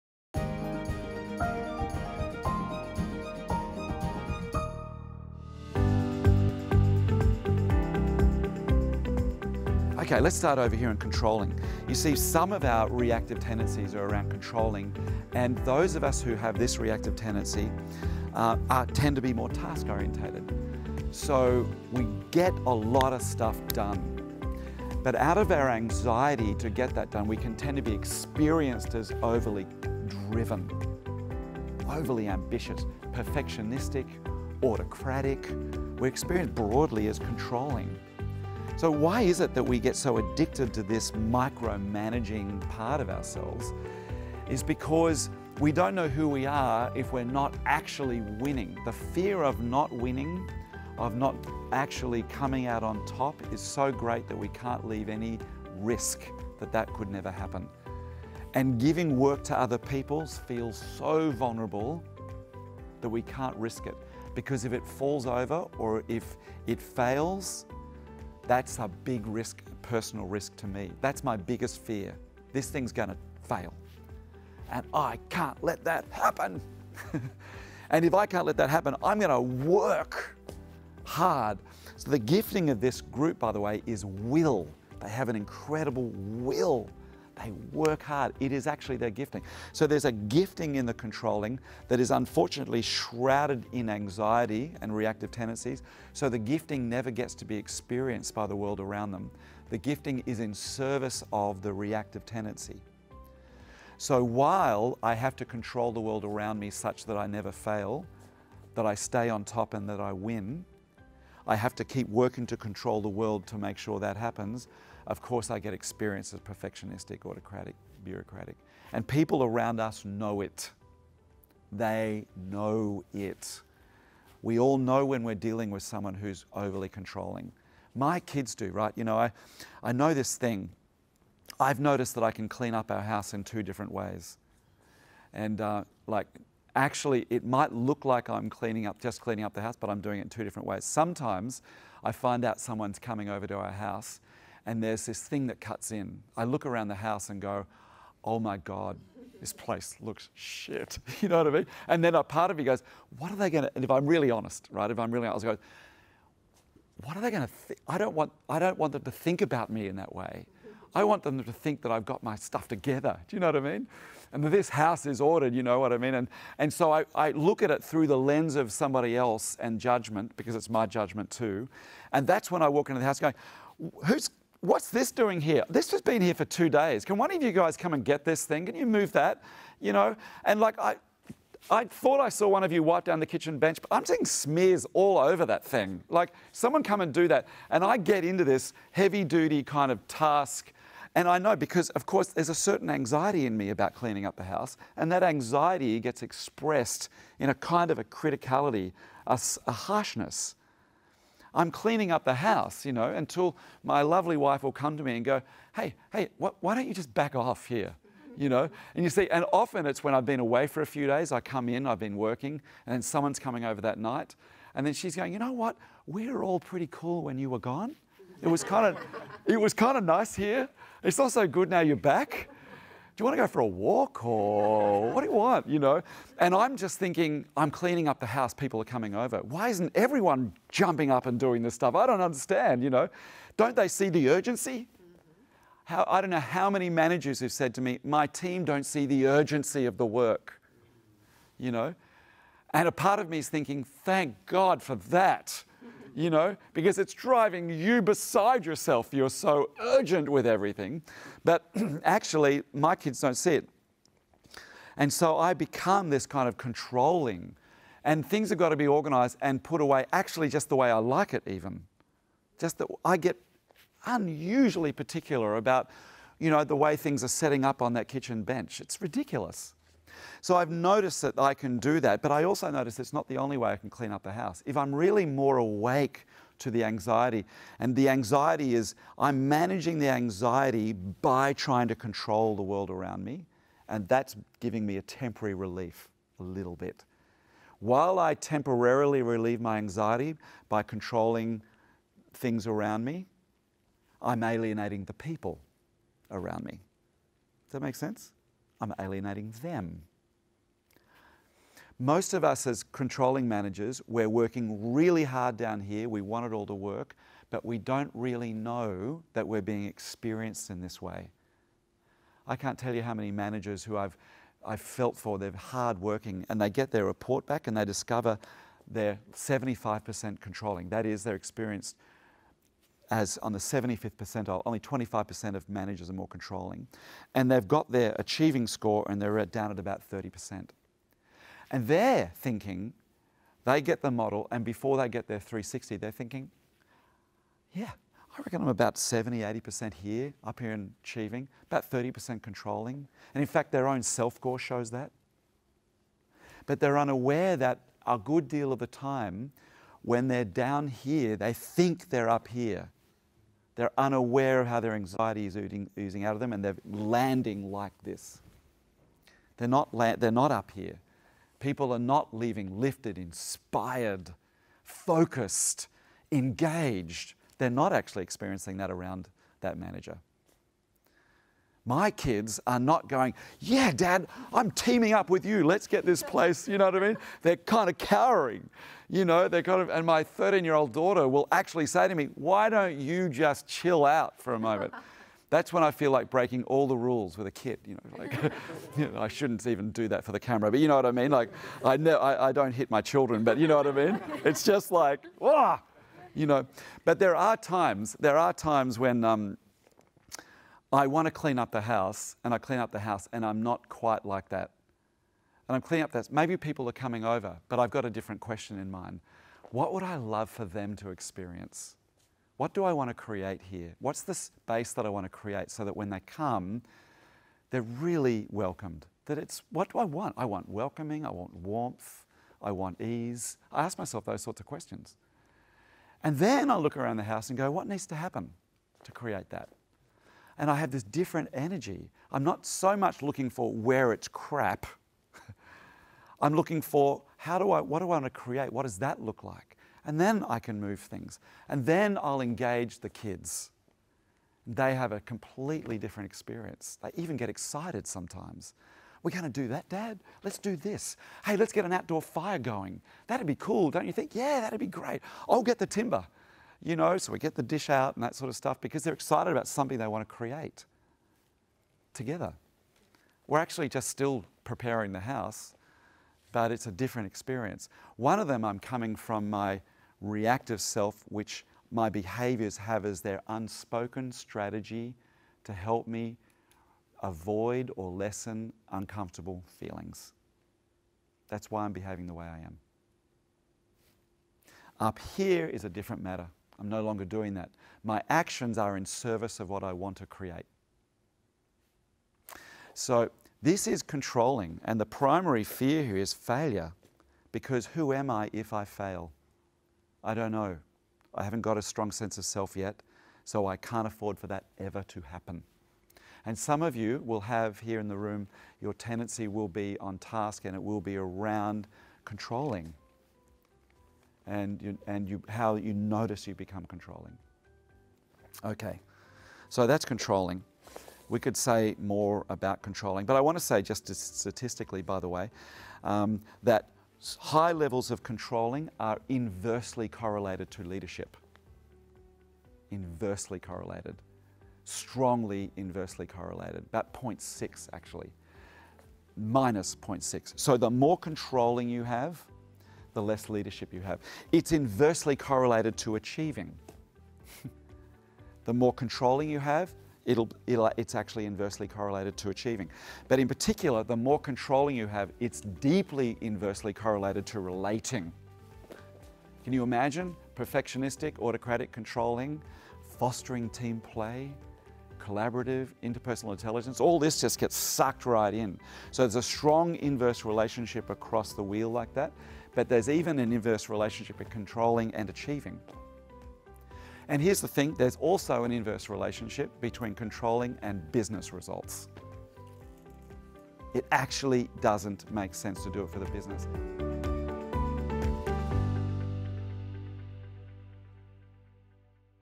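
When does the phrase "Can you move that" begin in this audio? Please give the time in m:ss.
2:58.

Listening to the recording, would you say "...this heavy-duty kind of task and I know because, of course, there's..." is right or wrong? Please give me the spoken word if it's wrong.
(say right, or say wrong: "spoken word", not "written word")
right.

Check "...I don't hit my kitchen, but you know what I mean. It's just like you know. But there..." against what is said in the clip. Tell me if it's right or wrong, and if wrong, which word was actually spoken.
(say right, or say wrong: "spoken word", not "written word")
wrong: "children", not "kitchen".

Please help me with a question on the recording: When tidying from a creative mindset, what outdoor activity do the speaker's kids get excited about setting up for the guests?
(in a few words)
an outdoor fire.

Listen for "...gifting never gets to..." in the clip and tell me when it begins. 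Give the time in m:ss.
1:36.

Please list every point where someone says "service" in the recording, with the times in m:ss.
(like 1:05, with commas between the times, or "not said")
1:40, 8:09.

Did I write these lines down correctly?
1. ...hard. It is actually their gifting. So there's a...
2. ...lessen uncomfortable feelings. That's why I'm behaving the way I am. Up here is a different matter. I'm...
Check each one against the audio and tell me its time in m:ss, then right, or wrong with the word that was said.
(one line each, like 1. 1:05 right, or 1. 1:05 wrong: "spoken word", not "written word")
1. 1:28 right
2. 7:58 right.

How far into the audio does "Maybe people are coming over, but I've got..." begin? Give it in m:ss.
6:46.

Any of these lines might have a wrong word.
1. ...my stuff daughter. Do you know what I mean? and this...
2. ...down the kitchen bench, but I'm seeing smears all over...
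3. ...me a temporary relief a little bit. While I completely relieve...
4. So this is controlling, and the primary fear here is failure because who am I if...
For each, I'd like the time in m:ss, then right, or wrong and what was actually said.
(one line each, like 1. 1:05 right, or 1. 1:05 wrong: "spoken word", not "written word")
1. 2:42 wrong: "together", not "daughter"
2. 3:03 right
3. 4:44 wrong: "temporarily", not "completely"
4. 8:12 right.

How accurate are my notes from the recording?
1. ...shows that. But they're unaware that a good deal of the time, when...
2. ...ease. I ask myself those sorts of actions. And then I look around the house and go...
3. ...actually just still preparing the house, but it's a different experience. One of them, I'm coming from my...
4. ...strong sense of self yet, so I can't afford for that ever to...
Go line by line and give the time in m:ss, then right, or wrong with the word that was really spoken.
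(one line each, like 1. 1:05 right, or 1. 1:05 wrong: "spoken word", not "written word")
1. 5:44 right
2. 7:02 wrong: "questions", not "actions"
3. 7:43 right
4. 8:21 right.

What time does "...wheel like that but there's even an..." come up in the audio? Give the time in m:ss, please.
9:31.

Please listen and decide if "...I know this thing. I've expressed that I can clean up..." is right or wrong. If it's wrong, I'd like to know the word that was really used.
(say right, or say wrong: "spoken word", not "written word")
wrong: "noticed", not "expressed".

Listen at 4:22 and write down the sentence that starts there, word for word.
Just that I get unusually particular about, you know, the way things are setting up on that kitchen bench.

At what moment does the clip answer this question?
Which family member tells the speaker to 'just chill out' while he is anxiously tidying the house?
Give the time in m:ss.
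6:20.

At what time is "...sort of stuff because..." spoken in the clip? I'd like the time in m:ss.
7:38.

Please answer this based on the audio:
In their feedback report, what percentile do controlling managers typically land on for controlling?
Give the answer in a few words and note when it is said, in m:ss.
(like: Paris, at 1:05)
75th percentile, at 5:23.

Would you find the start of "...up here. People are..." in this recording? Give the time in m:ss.
6:00.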